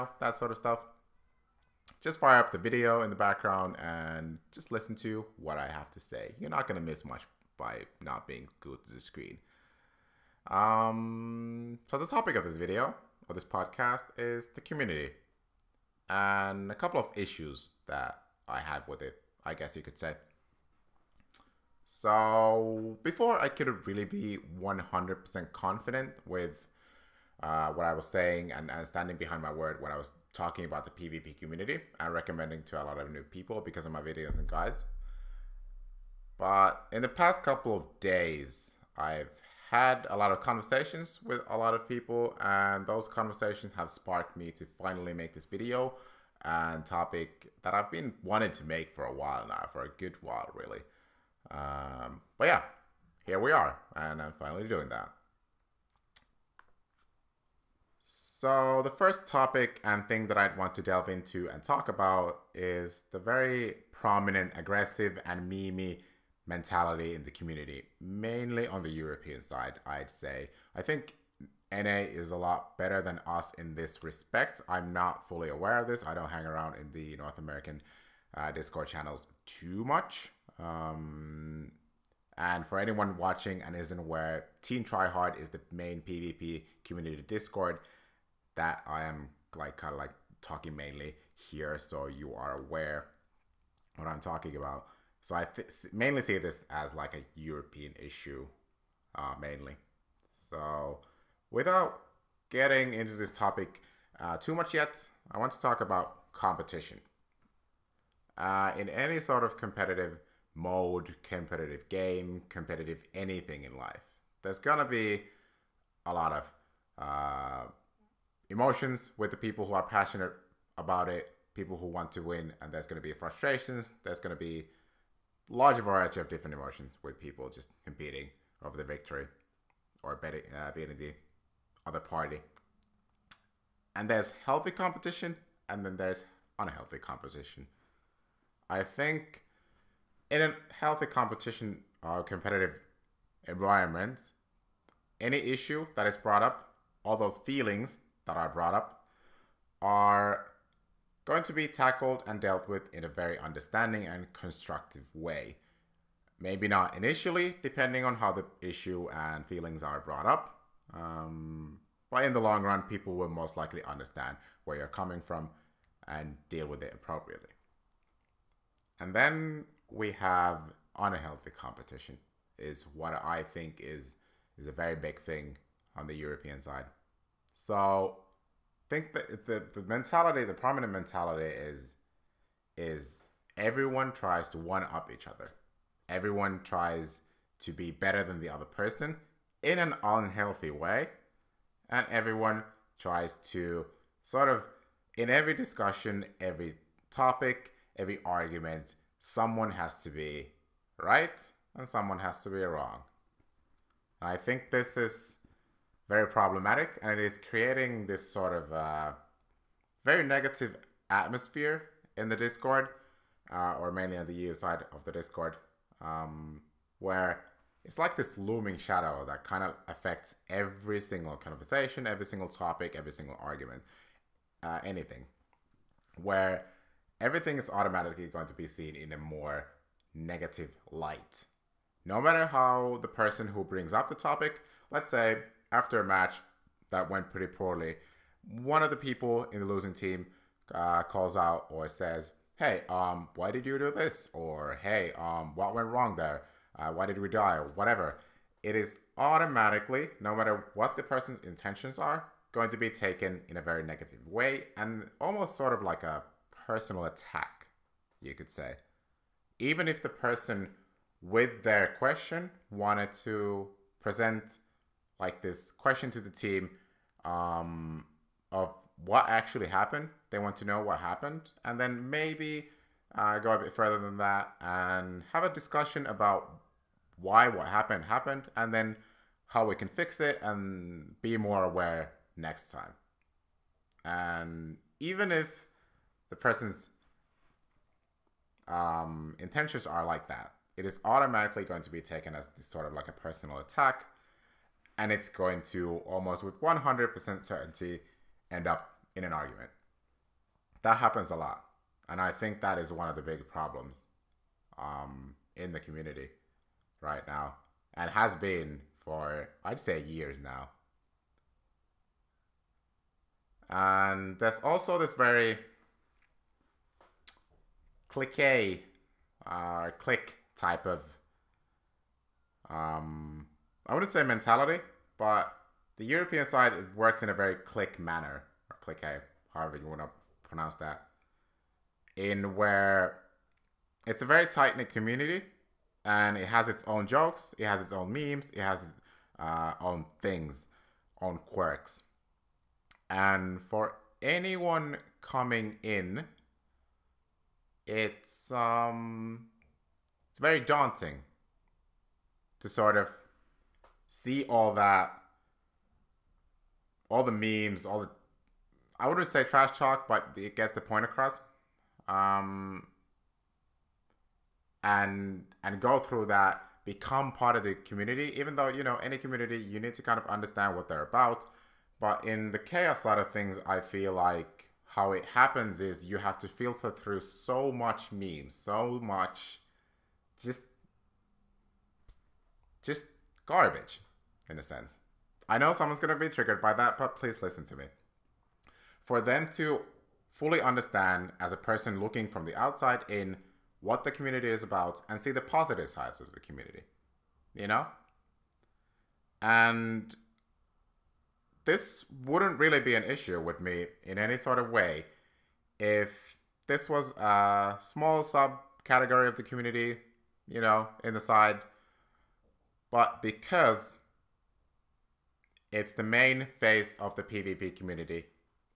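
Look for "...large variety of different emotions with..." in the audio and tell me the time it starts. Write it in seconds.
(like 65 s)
125 s.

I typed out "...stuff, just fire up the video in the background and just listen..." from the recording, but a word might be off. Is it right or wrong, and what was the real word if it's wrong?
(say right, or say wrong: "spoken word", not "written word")
right.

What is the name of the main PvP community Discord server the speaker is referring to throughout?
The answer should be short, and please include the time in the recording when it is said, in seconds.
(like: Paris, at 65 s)
Team Tryhard, at 84 s.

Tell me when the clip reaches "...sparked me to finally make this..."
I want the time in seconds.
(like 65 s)
43 s.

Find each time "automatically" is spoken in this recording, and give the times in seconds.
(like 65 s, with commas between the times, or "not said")
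227 s, 249 s, 291 s.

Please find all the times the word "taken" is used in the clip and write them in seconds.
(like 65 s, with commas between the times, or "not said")
252 s, 292 s.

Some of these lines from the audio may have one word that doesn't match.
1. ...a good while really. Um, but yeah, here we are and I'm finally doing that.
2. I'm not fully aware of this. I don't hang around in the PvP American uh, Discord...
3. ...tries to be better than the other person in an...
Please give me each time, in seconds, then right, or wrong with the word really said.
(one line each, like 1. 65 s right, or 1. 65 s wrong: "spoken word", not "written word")
1. 49 s right
2. 74 s wrong: "North", not "PvP"
3. 186 s right.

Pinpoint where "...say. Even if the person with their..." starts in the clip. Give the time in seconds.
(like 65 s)
258 s.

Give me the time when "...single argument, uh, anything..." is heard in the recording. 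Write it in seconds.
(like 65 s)
223 s.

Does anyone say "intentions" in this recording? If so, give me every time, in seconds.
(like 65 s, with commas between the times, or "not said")
251 s, 289 s.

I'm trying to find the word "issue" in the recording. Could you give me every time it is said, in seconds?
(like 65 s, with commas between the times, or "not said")
17 s, 97 s, 145 s, 158 s, 403 s.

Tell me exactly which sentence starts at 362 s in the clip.
Um, and and go through that, become part of the community.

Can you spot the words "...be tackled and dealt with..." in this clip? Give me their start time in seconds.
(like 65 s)
151 s.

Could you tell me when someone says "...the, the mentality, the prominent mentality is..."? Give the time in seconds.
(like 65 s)
179 s.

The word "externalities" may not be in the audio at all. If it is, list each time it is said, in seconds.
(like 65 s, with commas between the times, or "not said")
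not said.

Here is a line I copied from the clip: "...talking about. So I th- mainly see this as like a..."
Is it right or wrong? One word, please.
right.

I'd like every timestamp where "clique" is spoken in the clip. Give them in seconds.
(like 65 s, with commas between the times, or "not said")
318 s, 328 s.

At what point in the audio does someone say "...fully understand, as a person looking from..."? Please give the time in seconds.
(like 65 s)
390 s.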